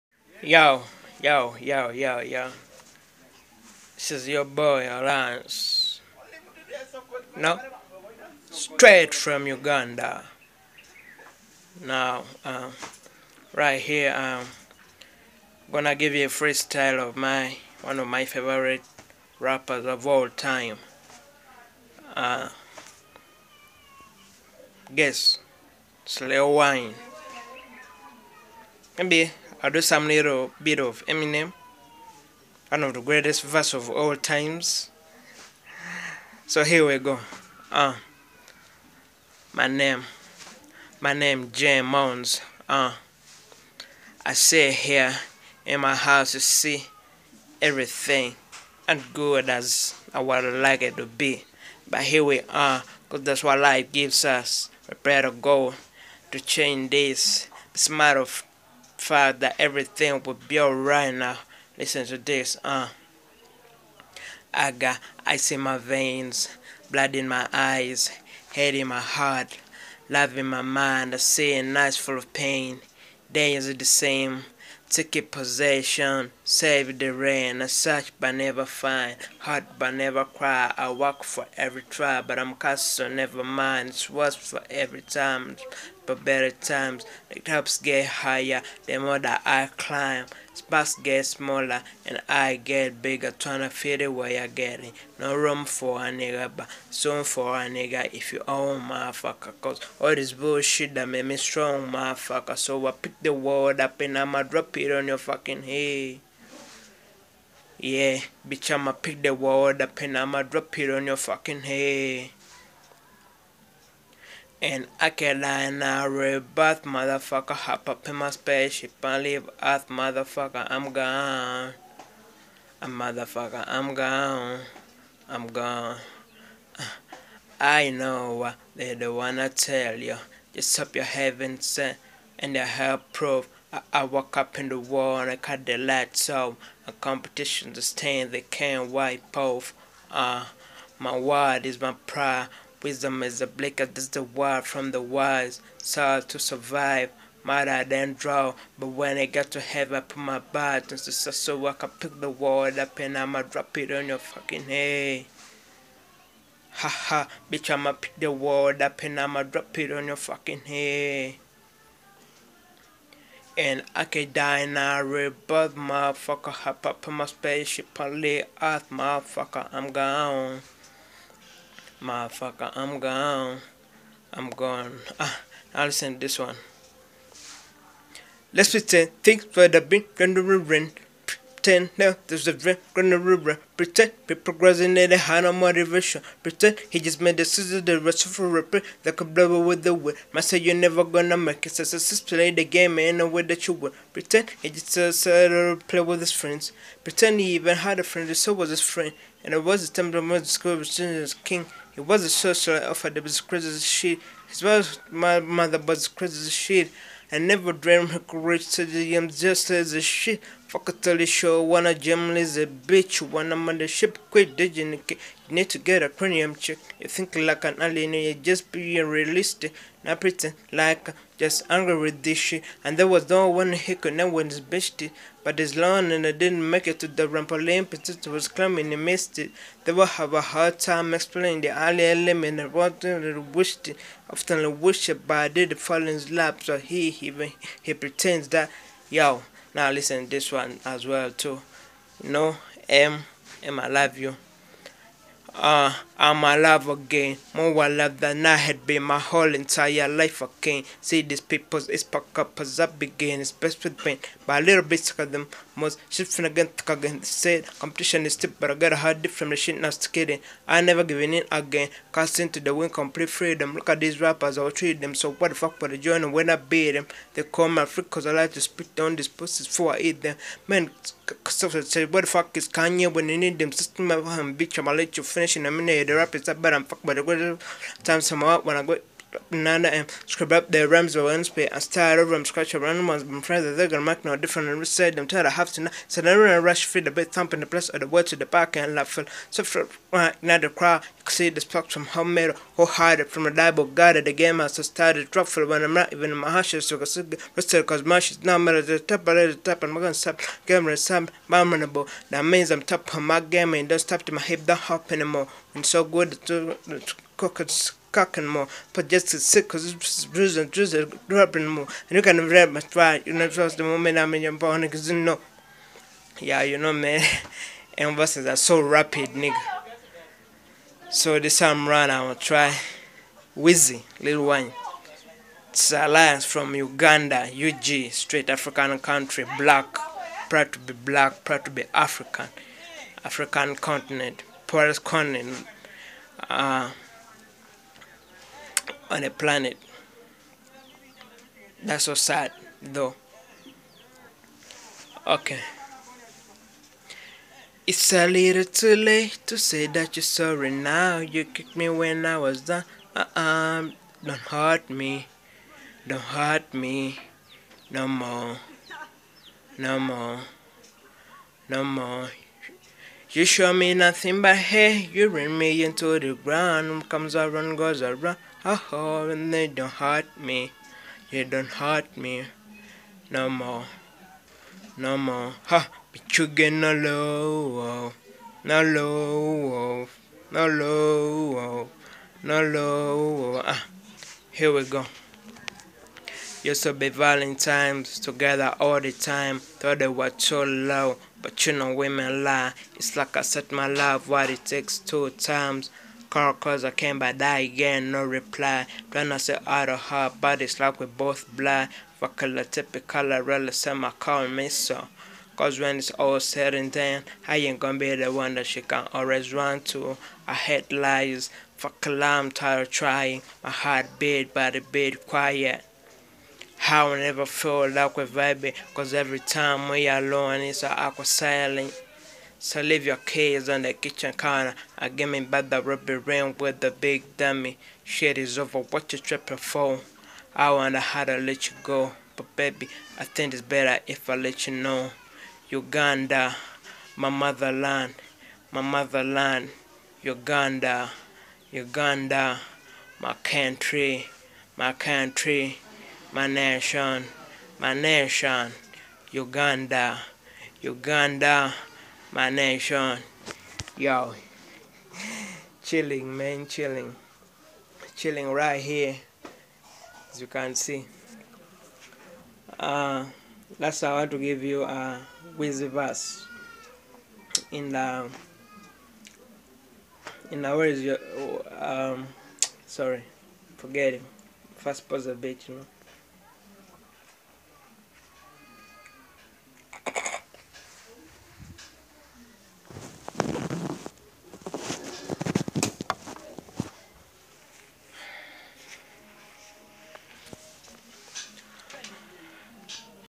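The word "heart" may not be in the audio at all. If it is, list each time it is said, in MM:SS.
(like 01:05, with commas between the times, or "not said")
01:08, 01:19, 06:53.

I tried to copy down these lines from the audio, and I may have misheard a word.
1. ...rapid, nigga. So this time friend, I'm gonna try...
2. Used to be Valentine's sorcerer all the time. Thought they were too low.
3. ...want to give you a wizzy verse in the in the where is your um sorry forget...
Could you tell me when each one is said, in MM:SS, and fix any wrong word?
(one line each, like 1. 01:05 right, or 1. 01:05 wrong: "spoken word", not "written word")
1. 05:18 wrong: "round", not "friend"
2. 06:26 wrong: "together", not "sorcerer"
3. 07:44 right.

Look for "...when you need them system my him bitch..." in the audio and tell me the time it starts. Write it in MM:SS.
04:33.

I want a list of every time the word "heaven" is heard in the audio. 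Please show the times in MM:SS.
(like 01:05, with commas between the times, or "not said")
02:11, 02:29.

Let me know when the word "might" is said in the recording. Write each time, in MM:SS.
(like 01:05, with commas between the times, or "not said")
02:27, 03:10.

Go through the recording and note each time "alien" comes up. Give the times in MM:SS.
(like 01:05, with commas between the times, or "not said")
03:37, 03:51.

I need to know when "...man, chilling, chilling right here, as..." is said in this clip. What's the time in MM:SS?
07:36.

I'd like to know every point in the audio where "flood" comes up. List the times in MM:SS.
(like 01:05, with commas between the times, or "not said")
not said.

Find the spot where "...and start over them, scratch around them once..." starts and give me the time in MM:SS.
04:41.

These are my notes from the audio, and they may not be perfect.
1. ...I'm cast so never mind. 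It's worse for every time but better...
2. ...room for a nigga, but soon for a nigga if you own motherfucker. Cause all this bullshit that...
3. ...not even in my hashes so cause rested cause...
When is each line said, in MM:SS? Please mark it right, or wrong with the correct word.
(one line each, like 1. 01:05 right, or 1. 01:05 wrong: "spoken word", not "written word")
1. 01:22 right
2. 01:35 right
3. 04:55 right.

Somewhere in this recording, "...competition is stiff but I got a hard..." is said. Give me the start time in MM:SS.
04:17.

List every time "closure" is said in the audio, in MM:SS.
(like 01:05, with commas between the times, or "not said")
not said.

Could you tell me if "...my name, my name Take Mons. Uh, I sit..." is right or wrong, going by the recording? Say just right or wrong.
wrong.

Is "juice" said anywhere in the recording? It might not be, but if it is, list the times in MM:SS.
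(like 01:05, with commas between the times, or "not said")
not said.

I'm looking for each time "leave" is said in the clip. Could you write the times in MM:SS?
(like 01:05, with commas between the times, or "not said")
01:59, 07:02.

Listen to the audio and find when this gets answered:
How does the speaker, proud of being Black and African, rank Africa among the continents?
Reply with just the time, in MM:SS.
05:34.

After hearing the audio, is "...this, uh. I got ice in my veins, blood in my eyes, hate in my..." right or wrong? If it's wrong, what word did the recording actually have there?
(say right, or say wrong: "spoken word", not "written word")
right.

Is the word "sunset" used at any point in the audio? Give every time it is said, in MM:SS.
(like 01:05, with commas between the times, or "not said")
not said.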